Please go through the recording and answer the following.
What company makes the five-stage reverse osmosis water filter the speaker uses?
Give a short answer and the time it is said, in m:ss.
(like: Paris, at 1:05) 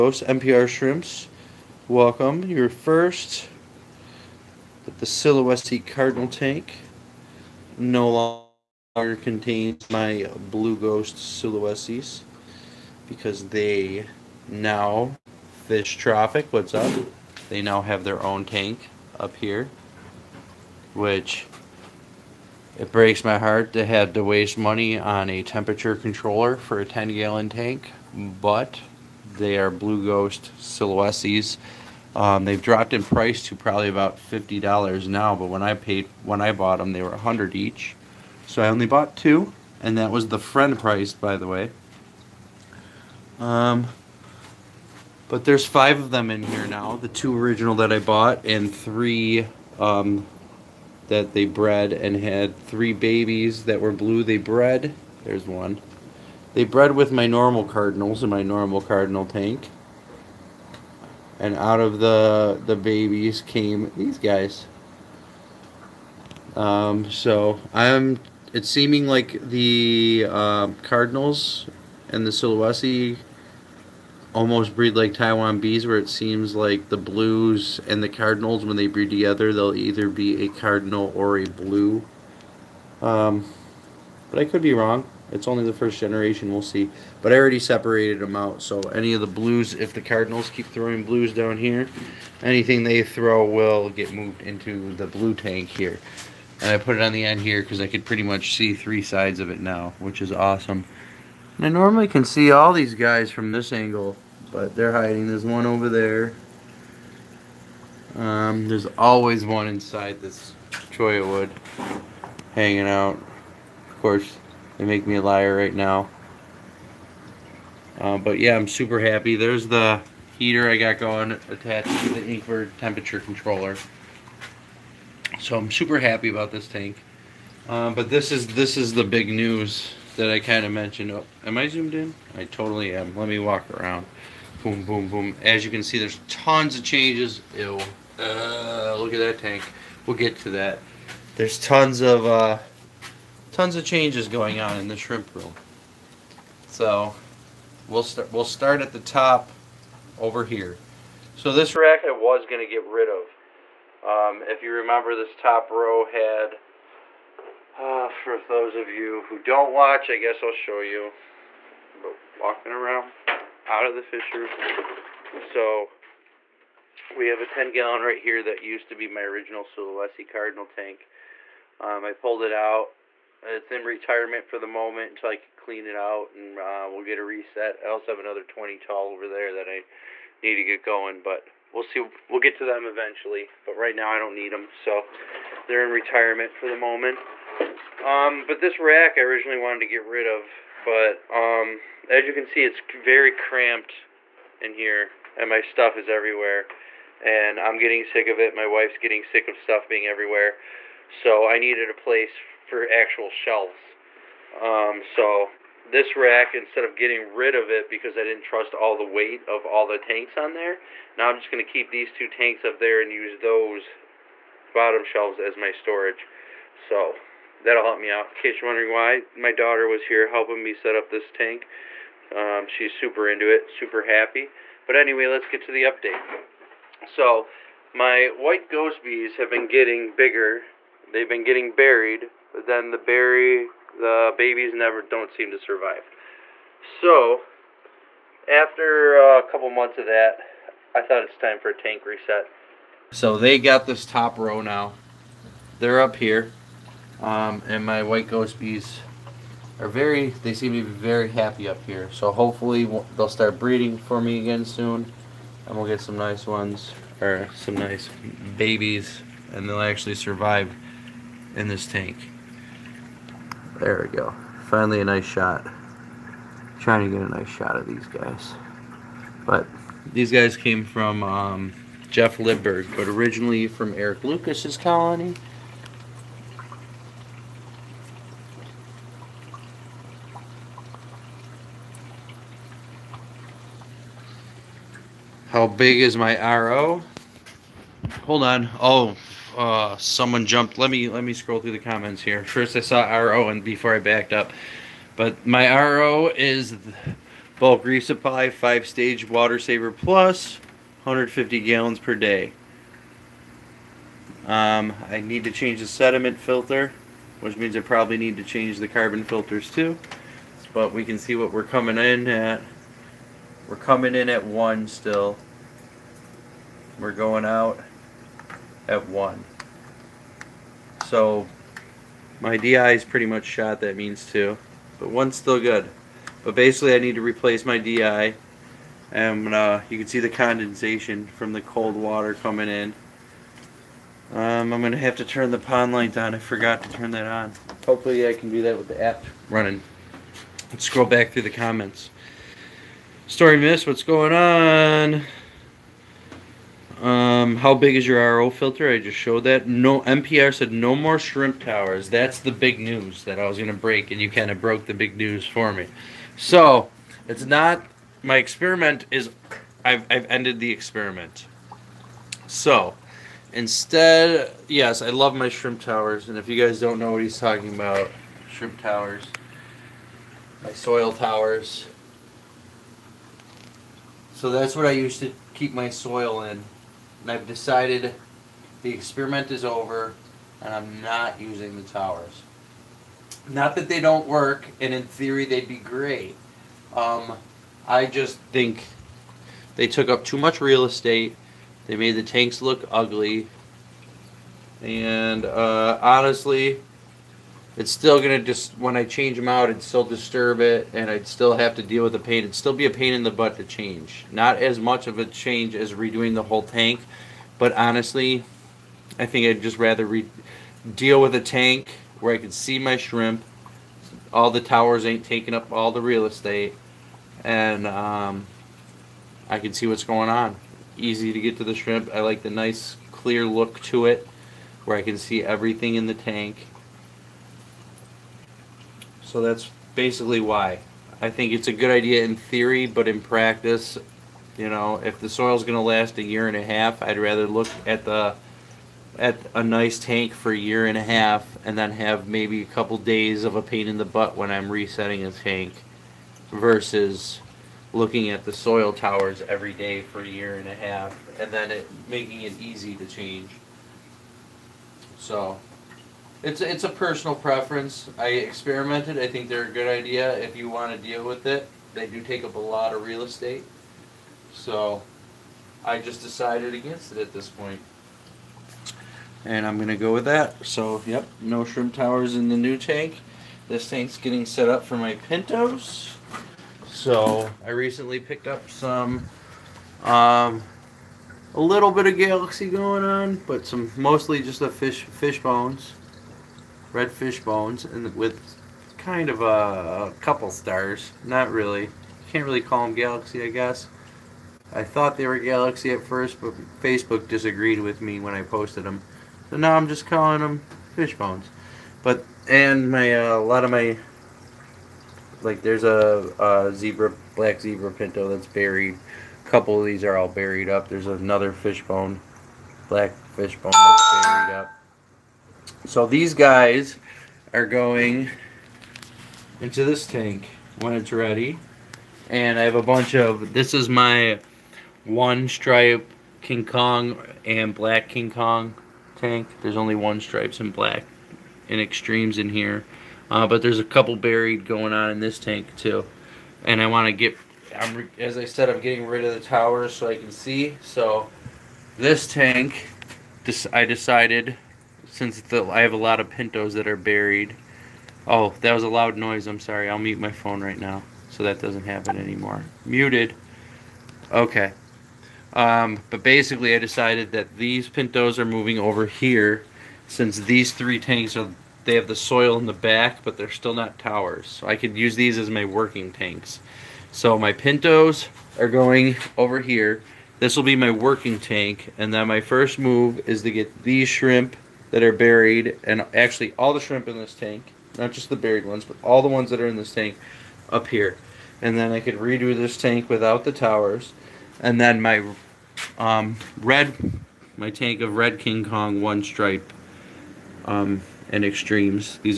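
Bulk Reef Supply, at 4:57.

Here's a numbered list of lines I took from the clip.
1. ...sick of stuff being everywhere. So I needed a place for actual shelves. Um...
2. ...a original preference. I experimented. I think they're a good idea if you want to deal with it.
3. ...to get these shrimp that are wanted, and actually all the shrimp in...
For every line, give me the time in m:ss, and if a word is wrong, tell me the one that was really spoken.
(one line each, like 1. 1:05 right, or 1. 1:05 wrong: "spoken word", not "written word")
1. 3:19 right
2. 7:36 wrong: "personal", not "original"
3. 9:33 wrong: "buried", not "wanted".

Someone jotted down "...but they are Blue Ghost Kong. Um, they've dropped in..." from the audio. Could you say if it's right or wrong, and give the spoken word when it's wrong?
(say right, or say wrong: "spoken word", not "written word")
wrong: "Sulawesis", not "Kong".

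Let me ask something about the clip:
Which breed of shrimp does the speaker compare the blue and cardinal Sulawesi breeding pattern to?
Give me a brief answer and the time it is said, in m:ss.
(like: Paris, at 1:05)
Taiwan bees, at 1:15.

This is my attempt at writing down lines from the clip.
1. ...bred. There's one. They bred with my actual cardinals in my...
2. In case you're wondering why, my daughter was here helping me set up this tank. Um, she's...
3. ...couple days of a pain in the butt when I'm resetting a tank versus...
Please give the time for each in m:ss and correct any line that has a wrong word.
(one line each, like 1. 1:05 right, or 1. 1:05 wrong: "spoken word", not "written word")
1. 0:54 wrong: "normal", not "actual"
2. 3:38 right
3. 7:22 right.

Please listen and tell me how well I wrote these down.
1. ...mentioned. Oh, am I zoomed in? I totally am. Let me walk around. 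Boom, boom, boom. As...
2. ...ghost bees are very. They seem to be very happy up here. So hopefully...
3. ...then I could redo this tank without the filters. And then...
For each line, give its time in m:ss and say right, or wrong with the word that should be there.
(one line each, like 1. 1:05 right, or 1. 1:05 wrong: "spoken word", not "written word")
1. 2:10 right
2. 4:08 right
3. 9:41 wrong: "towers", not "filters".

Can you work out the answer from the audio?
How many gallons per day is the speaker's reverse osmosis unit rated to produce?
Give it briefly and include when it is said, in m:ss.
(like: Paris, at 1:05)
150, at 5:01.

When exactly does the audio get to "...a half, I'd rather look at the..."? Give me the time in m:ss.
7:16.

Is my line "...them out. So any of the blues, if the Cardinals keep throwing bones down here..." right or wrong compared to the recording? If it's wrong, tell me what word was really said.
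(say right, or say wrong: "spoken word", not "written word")
wrong: "blues", not "bones".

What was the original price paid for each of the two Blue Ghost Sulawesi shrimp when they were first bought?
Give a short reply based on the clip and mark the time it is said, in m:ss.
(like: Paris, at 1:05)
$100, at 0:36.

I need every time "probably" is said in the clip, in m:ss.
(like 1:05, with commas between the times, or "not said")
0:33, 5:07.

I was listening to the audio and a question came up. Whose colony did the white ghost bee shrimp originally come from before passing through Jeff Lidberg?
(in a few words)
Eric Lucas.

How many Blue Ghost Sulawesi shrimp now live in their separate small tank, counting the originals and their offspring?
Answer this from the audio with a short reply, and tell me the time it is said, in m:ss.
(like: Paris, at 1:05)
5, at 0:45.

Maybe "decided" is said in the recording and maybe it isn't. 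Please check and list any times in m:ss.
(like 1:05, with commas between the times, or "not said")
6:17, 7:46, 9:03, 9:16.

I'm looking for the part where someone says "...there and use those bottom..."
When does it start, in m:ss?
3:32.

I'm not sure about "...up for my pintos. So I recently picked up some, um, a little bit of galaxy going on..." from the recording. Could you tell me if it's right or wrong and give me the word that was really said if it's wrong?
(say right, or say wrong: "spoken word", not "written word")
right.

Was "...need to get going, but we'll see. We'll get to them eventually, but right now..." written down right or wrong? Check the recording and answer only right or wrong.
right.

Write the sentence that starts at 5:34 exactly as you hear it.
Um, I'm going to have to turn the pond light on.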